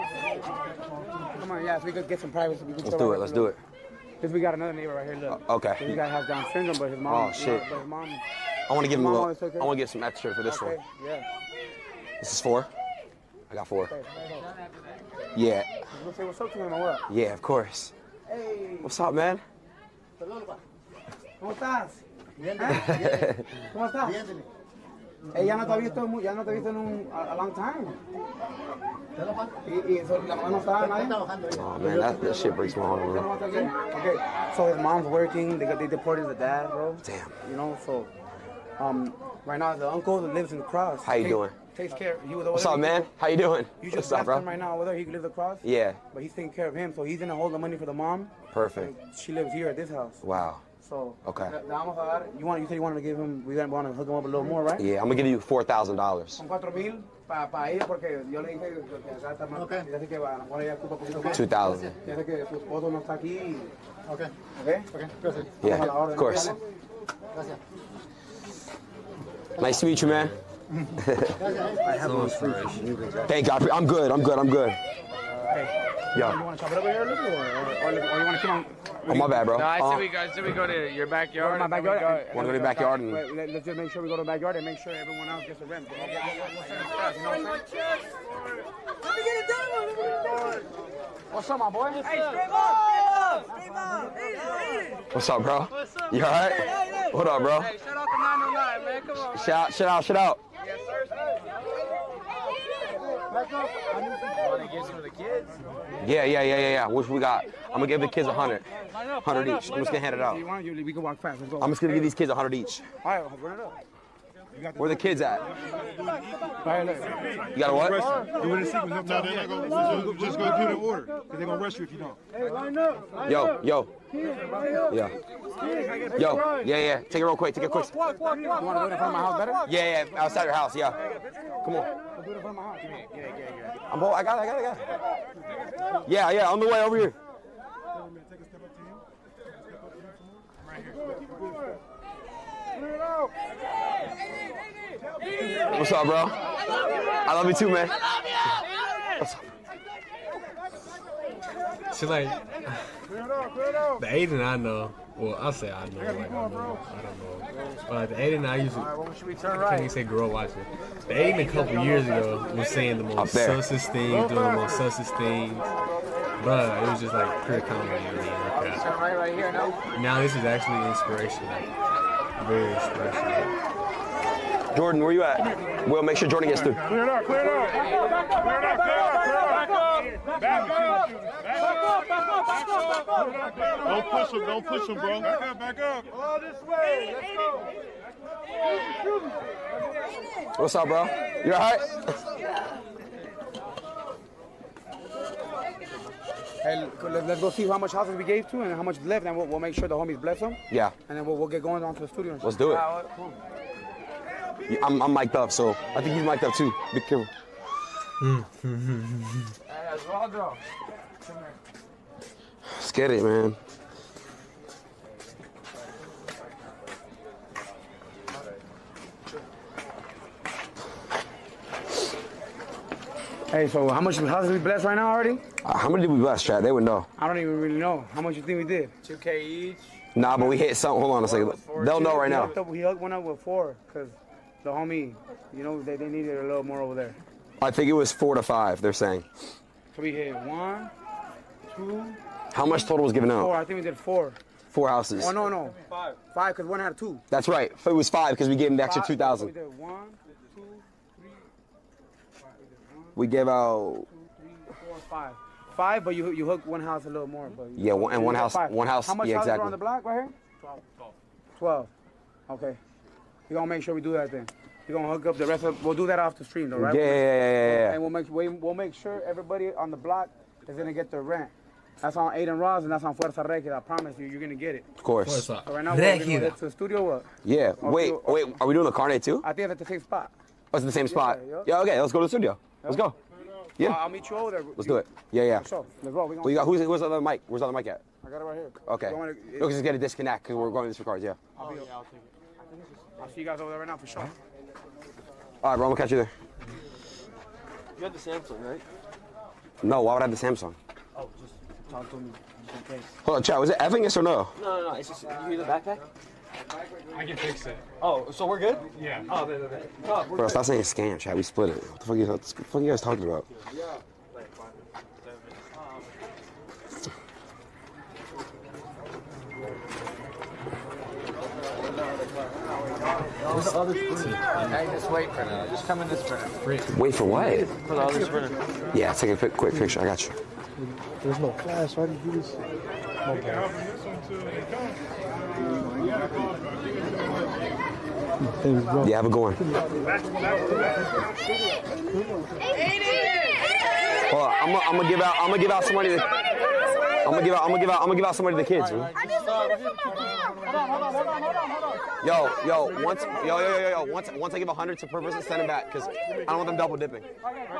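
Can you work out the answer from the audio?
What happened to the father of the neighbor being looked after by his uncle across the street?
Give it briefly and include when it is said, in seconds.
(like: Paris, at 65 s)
Deported, at 35 s.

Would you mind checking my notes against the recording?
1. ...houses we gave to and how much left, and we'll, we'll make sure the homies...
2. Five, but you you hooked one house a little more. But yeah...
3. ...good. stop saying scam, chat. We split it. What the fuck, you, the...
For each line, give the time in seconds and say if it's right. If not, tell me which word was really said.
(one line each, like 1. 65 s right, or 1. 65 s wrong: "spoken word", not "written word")
1. 197 s right
2. 255 s right
3. 310 s right.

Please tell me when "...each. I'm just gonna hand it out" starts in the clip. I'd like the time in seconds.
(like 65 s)
109 s.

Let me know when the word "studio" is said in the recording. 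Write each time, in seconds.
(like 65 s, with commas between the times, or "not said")
202 s, 276 s, 282 s.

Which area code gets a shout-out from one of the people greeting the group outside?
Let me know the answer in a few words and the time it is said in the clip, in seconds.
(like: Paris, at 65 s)
909, at 97 s.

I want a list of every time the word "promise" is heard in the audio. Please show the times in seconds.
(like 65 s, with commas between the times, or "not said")
273 s.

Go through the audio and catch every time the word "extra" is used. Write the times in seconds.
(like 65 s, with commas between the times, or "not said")
10 s, 248 s.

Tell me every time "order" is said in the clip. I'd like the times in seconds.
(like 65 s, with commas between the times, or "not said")
120 s.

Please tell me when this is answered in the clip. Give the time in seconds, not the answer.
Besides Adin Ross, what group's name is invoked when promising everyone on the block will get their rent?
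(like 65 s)
273 s.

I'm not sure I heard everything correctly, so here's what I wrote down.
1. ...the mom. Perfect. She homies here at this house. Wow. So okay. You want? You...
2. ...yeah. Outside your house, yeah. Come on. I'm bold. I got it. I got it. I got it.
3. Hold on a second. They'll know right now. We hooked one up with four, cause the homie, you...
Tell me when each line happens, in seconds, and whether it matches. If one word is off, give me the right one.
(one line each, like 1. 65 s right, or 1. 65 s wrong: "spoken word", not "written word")
1. 47 s wrong: "lives", not "homies"
2. 130 s right
3. 231 s right.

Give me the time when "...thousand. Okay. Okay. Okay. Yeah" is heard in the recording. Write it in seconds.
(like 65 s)
61 s.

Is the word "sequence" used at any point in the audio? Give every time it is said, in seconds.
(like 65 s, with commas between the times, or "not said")
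118 s.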